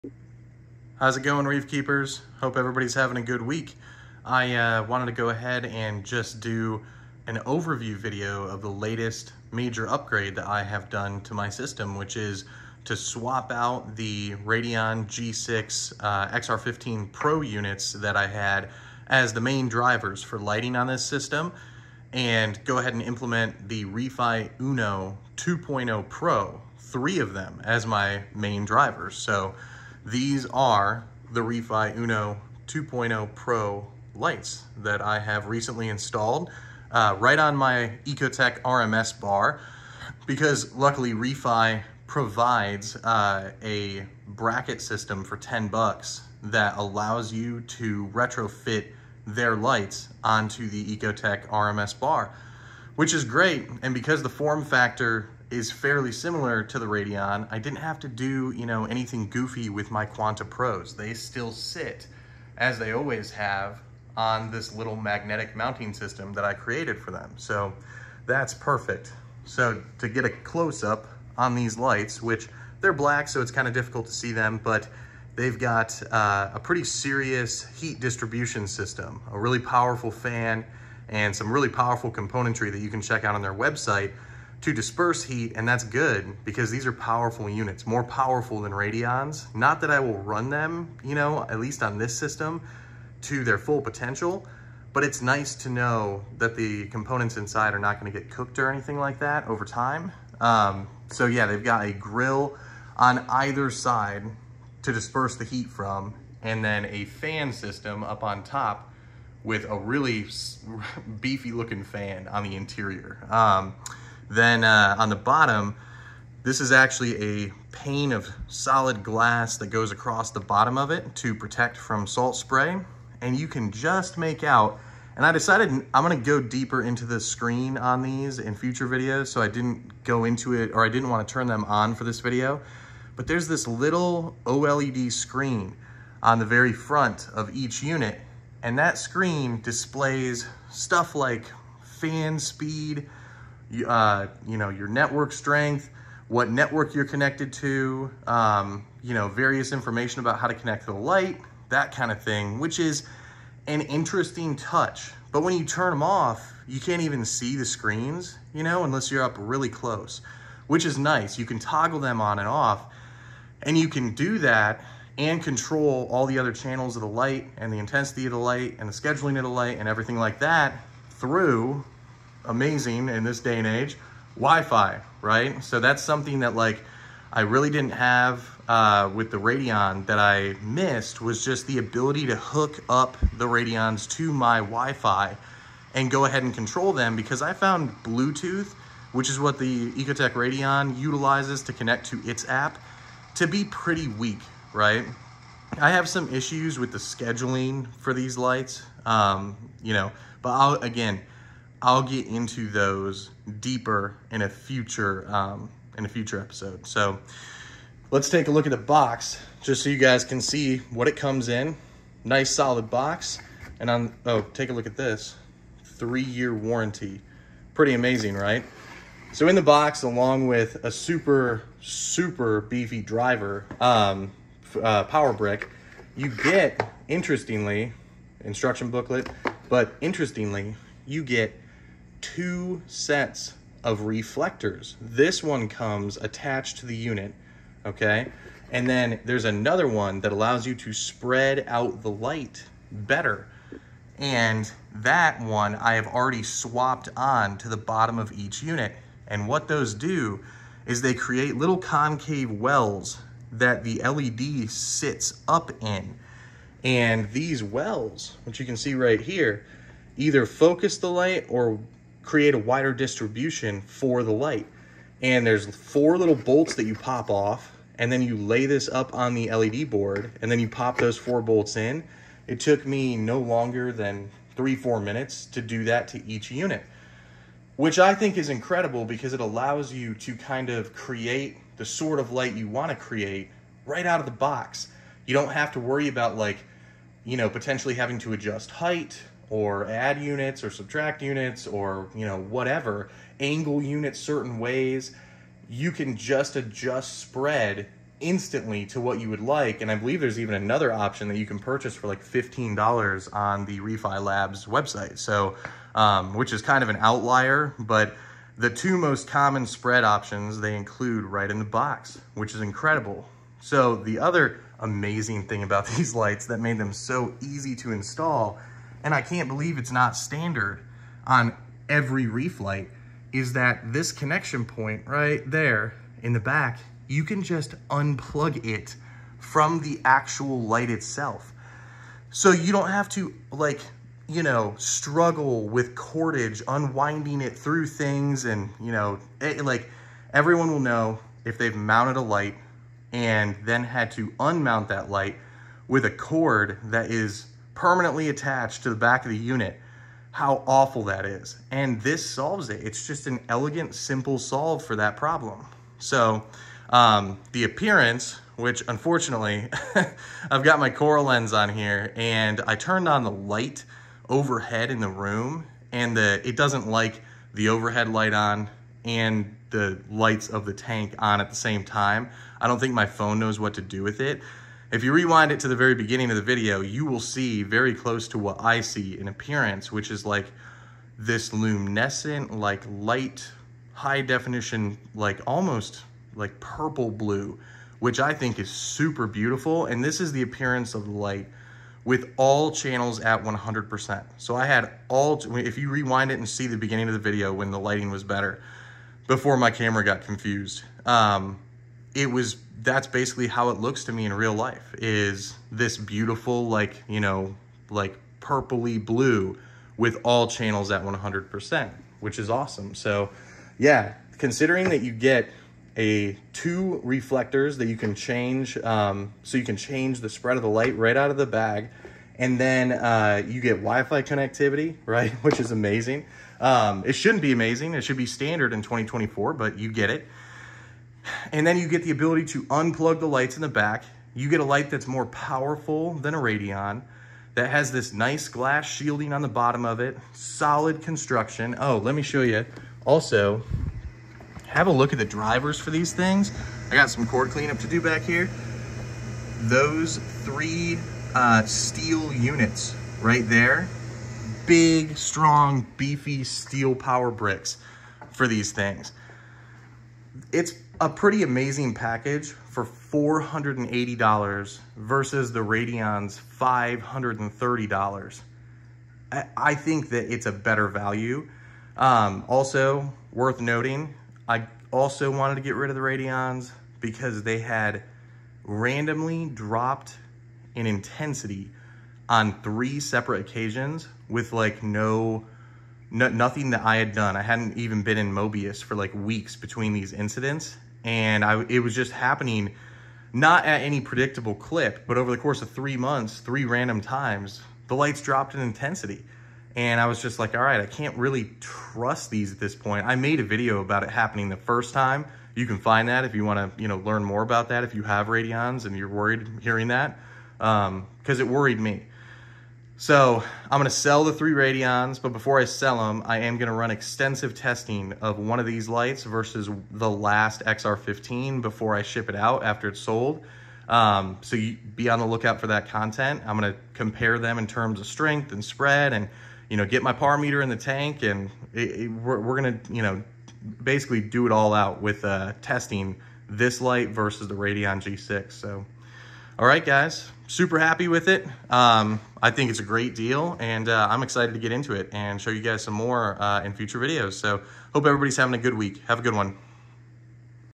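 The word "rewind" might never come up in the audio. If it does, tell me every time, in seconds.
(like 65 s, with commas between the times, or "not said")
375 s, 395 s.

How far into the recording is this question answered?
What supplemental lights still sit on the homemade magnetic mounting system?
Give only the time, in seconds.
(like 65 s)
60 s.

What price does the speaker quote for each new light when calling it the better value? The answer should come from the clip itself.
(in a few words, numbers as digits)
$480.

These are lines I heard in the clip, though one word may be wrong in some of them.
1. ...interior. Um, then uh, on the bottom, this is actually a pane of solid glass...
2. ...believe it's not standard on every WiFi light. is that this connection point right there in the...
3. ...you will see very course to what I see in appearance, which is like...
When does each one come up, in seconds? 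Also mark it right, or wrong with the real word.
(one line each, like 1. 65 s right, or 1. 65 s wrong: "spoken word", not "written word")
1. 112 s right
2. 319 s wrong: "Reef", not "WiFi"
3. 376 s wrong: "close", not "course".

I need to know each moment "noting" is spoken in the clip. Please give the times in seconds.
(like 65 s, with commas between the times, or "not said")
473 s.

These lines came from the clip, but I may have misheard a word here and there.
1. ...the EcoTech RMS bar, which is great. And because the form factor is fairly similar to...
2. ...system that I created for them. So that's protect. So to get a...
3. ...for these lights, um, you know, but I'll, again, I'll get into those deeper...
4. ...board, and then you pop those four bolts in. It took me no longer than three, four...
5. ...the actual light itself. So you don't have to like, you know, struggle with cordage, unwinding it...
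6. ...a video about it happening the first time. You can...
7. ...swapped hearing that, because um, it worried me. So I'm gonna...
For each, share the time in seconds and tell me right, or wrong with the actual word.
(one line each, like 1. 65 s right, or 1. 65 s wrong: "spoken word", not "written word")
1. 50 s right
2. 65 s wrong: "perfect", not "protect"
3. 197 s right
4. 269 s right
5. 329 s right
6. 503 s right
7. 509 s wrong: "worried", not "swapped".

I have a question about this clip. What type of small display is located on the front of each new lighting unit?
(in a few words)
OLED screen.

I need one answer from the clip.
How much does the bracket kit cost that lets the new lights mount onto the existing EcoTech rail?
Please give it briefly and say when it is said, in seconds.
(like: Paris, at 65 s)
$10, at 45 s.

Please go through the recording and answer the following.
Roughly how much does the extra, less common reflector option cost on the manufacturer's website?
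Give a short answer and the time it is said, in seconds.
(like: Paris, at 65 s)
$15, at 302 s.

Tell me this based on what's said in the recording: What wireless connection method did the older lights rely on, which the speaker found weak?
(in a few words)
Bluetooth.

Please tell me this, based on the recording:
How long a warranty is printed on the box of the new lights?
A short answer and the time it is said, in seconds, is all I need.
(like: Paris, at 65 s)
3 years, at 215 s.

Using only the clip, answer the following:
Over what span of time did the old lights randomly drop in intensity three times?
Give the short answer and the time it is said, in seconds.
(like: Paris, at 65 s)
3 months, at 495 s.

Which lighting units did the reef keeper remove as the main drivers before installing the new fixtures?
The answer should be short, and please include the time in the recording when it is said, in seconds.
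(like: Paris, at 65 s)
Radion G6 XR15 Pro, at 14 s.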